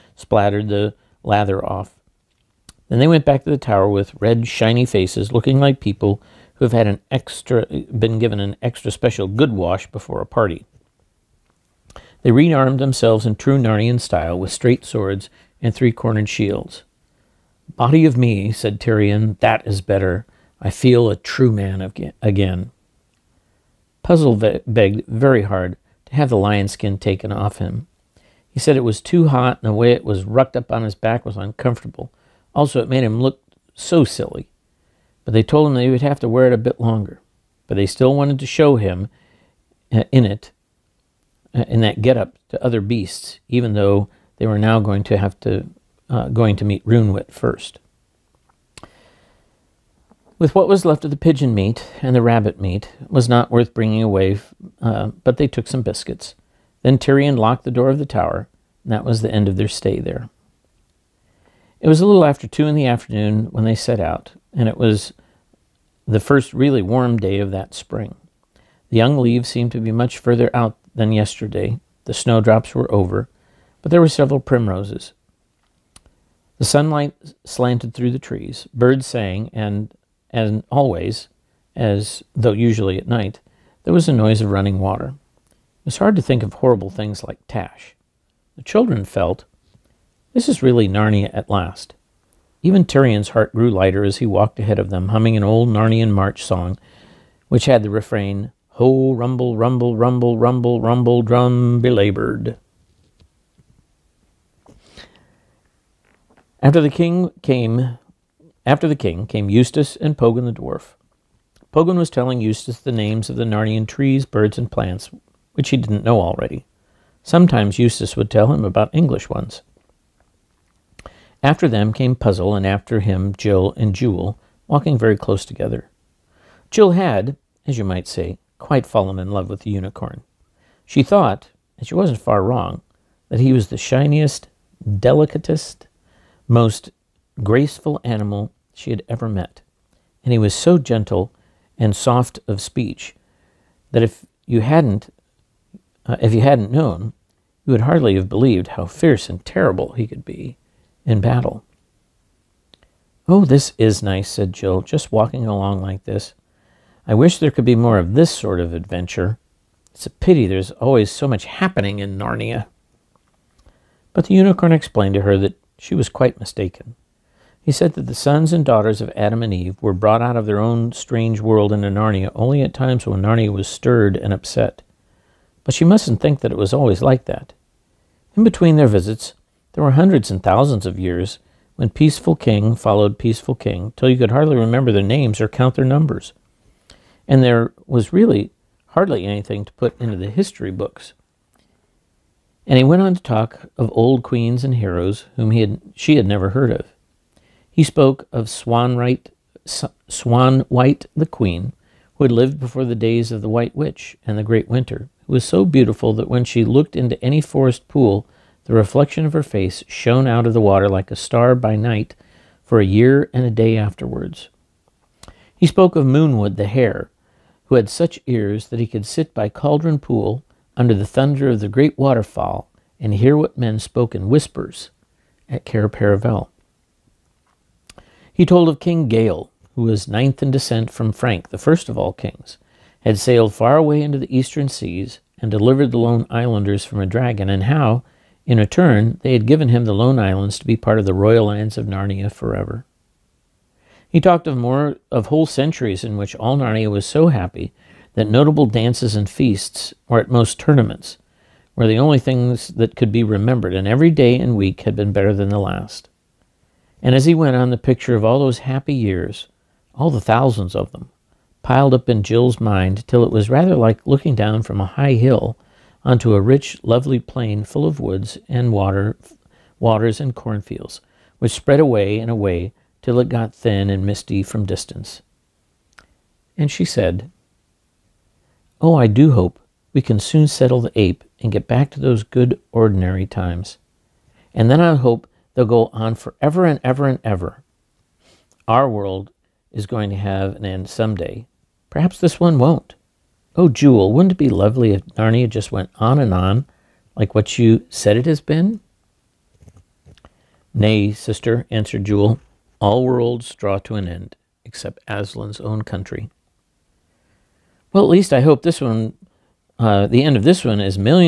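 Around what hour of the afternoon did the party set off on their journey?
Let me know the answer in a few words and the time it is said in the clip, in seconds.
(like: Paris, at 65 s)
2, at 62 s.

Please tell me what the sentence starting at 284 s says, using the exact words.
And then I hope They'll go on forever and ever and ever.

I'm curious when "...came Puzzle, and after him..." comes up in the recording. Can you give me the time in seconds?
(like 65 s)
121 s.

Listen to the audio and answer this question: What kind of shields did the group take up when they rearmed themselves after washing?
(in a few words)
Three-cornered shields.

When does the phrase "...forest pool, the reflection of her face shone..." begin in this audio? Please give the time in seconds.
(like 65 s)
207 s.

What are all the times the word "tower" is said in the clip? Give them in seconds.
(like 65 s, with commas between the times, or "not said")
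3 s, 58 s.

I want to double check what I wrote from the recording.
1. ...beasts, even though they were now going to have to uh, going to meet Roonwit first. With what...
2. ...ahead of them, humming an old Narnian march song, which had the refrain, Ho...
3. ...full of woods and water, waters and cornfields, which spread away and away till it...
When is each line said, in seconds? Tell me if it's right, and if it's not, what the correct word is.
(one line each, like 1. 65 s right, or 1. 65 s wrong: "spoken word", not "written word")
1. 42 s right
2. 94 s right
3. 267 s right.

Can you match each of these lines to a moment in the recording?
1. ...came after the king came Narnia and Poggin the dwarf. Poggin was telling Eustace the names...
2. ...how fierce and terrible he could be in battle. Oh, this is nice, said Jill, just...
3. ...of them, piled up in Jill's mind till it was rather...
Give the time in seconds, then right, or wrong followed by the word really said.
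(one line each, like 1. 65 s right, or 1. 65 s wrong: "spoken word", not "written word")
1. 107 s wrong: "Eustace", not "Narnia"
2. 148 s right
3. 260 s right.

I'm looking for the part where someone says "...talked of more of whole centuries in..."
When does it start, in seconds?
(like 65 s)
244 s.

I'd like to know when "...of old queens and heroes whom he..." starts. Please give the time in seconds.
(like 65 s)
193 s.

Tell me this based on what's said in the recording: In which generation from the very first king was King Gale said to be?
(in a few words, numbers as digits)
9th.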